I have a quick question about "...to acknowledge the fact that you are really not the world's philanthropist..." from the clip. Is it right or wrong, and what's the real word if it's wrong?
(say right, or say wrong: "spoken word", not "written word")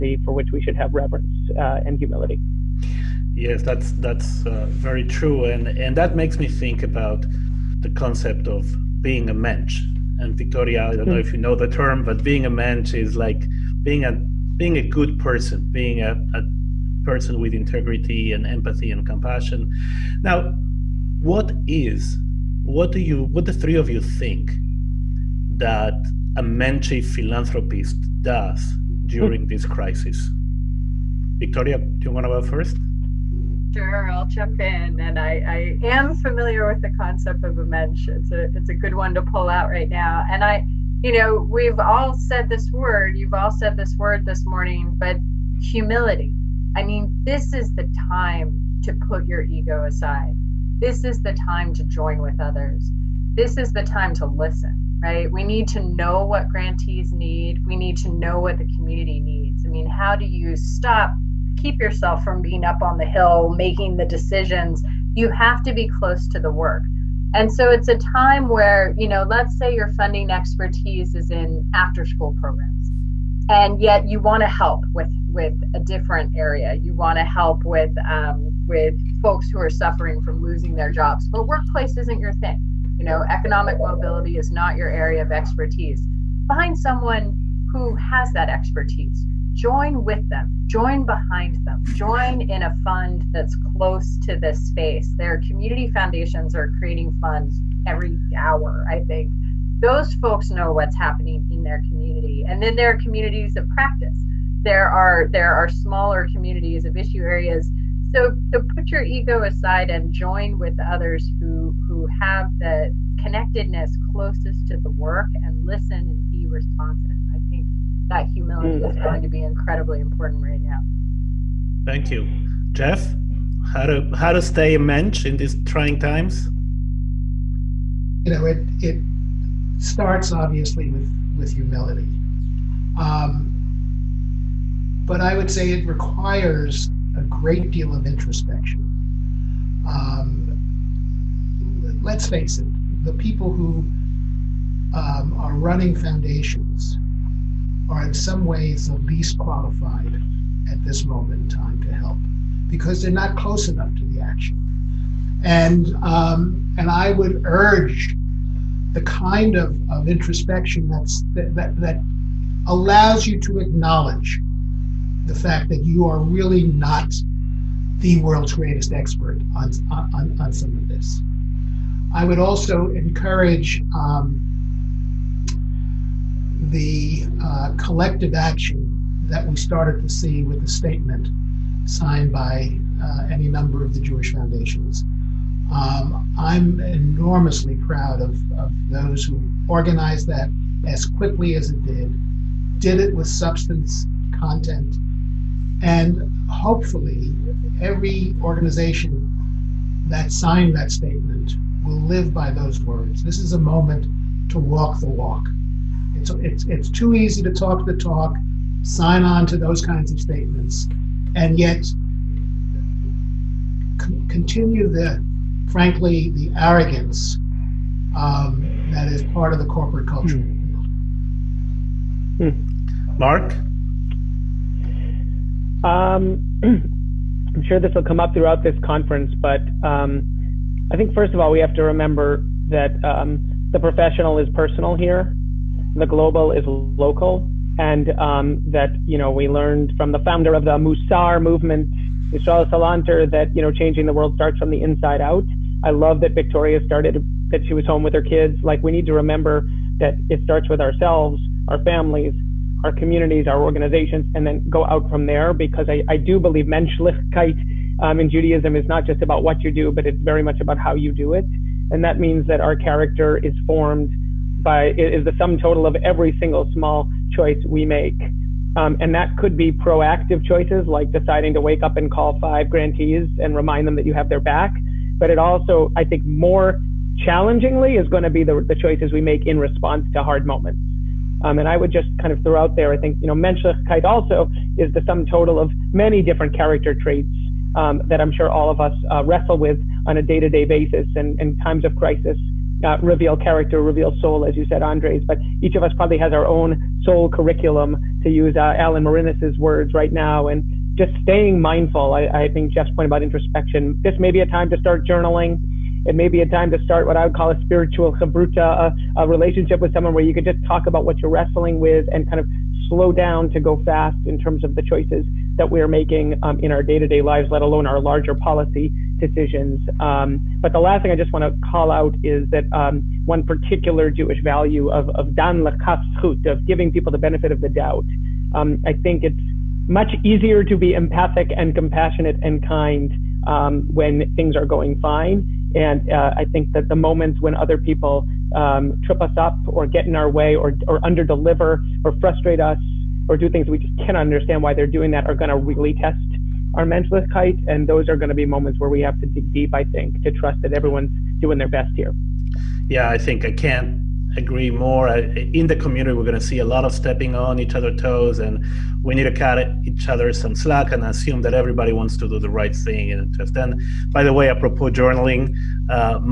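wrong: "greatest", not "philanthropist".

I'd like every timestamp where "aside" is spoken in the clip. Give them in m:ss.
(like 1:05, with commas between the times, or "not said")
0:49, 1:49.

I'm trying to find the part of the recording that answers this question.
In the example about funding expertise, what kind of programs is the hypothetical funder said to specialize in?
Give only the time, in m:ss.
1:11.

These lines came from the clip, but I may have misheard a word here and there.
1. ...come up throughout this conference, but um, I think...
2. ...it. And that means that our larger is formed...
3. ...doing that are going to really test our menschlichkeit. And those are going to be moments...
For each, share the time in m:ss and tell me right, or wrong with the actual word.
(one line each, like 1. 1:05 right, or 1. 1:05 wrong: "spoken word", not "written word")
1. 3:48 right
2. 4:21 wrong: "character", not "larger"
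3. 5:44 right.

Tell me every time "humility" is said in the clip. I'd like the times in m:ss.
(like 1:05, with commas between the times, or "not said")
0:01, 0:45, 1:58, 2:11.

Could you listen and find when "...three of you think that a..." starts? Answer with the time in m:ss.
0:23.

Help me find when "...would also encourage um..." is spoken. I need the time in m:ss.
2:52.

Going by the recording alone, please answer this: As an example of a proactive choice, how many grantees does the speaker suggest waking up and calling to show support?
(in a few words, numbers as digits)
5.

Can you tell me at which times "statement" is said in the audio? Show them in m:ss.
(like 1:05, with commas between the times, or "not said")
3:00, 3:20, 3:30.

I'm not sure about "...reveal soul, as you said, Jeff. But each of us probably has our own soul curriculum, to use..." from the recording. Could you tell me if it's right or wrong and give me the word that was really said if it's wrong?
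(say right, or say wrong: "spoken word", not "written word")
wrong: "Andres", not "Jeff".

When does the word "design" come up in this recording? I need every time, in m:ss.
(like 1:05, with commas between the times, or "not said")
not said.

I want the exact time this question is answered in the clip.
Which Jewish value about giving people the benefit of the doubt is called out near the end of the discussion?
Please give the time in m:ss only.
5:25.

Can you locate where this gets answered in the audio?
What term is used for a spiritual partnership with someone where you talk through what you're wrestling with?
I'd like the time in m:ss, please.
5:07.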